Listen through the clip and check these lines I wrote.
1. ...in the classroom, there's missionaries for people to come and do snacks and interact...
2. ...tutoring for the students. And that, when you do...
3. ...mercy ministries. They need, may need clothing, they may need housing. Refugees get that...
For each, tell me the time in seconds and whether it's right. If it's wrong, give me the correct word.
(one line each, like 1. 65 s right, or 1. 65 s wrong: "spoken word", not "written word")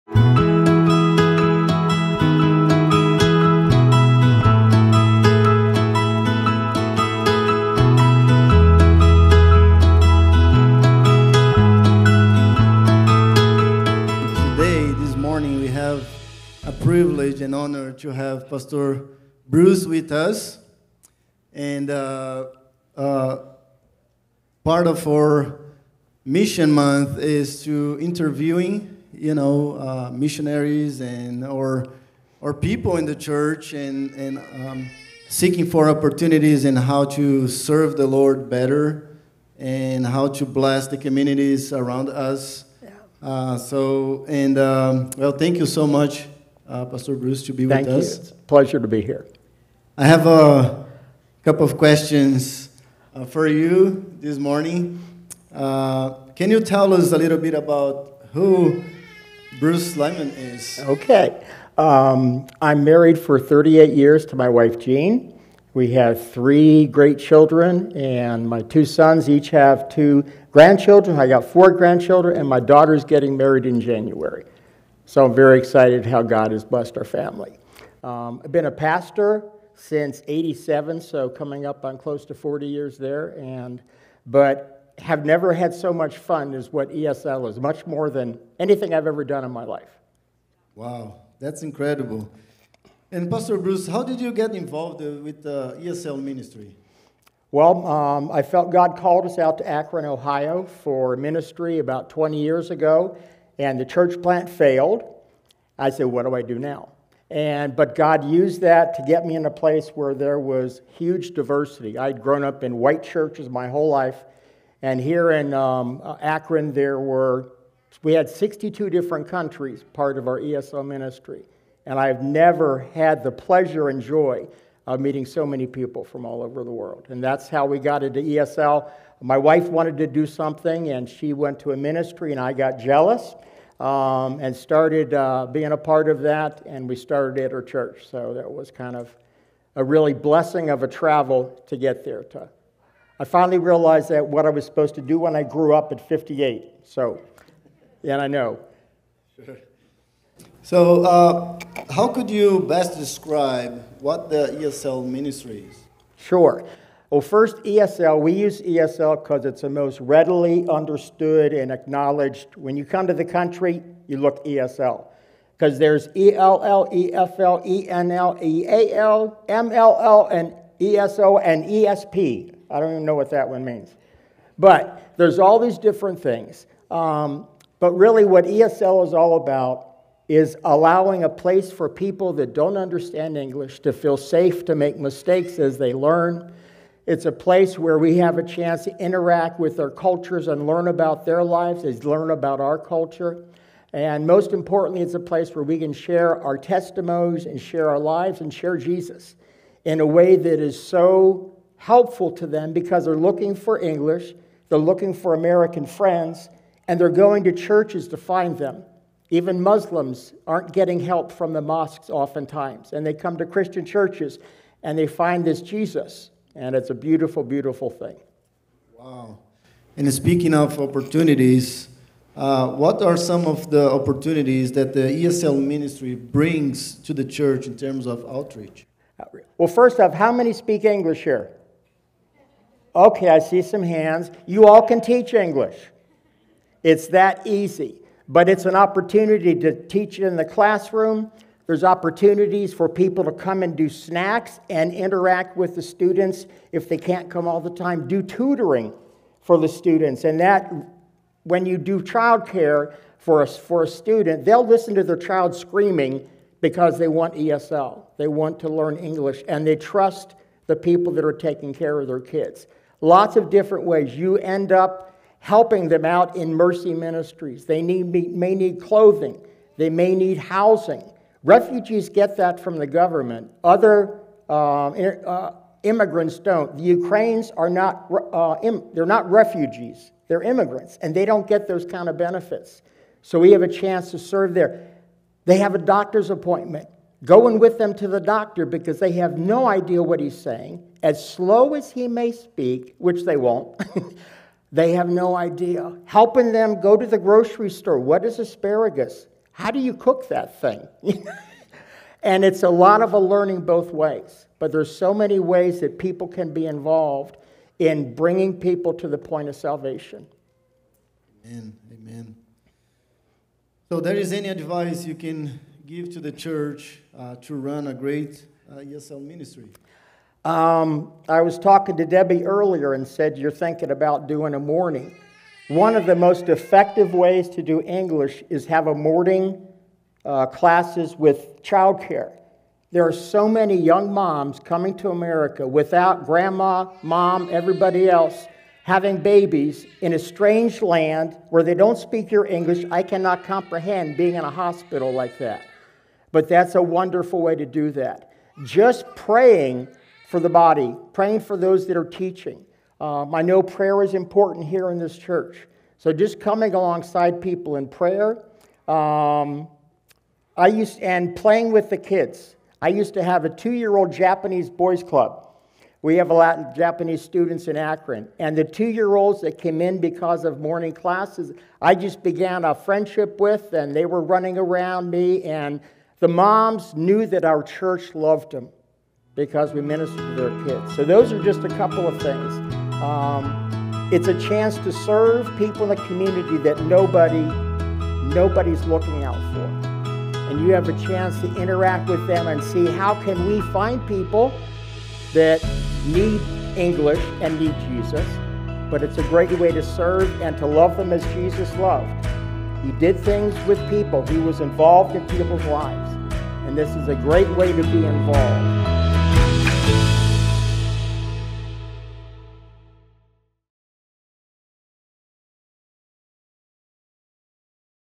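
1. 240 s wrong: "opportunities", not "missionaries"
2. 248 s right
3. 266 s right.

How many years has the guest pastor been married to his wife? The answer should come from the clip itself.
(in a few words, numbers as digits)
38.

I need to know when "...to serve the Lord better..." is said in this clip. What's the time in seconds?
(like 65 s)
37 s.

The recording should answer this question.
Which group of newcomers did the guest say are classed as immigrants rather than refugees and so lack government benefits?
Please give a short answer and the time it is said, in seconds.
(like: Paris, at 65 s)
Ukrainians, at 276 s.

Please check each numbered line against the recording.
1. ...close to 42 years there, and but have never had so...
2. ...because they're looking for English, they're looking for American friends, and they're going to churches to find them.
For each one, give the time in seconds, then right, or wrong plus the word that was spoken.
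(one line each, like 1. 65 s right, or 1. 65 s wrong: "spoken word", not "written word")
1. 81 s wrong: "40", not "42"
2. 202 s right.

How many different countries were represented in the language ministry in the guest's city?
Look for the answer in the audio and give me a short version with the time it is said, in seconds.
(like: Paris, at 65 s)
62, at 118 s.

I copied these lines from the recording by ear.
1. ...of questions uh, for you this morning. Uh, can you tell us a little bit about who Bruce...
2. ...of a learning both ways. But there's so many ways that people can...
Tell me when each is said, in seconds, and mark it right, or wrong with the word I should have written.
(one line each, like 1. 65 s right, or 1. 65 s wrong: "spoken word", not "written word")
1. 51 s right
2. 303 s right.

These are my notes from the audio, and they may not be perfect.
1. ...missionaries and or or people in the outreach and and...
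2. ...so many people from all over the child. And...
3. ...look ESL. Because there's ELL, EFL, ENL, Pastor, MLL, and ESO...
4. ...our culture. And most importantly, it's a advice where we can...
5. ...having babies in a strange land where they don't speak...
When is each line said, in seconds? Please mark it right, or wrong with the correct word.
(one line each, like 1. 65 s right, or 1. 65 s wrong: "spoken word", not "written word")
1. 30 s wrong: "church", not "outreach"
2. 125 s wrong: "world", not "child"
3. 164 s wrong: "EAL", not "Pastor"
4. 192 s wrong: "place", not "advice"
5. 338 s right.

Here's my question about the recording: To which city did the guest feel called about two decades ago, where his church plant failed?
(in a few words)
Akron, Ohio.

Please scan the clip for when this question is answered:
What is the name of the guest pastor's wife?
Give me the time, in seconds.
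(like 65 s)
64 s.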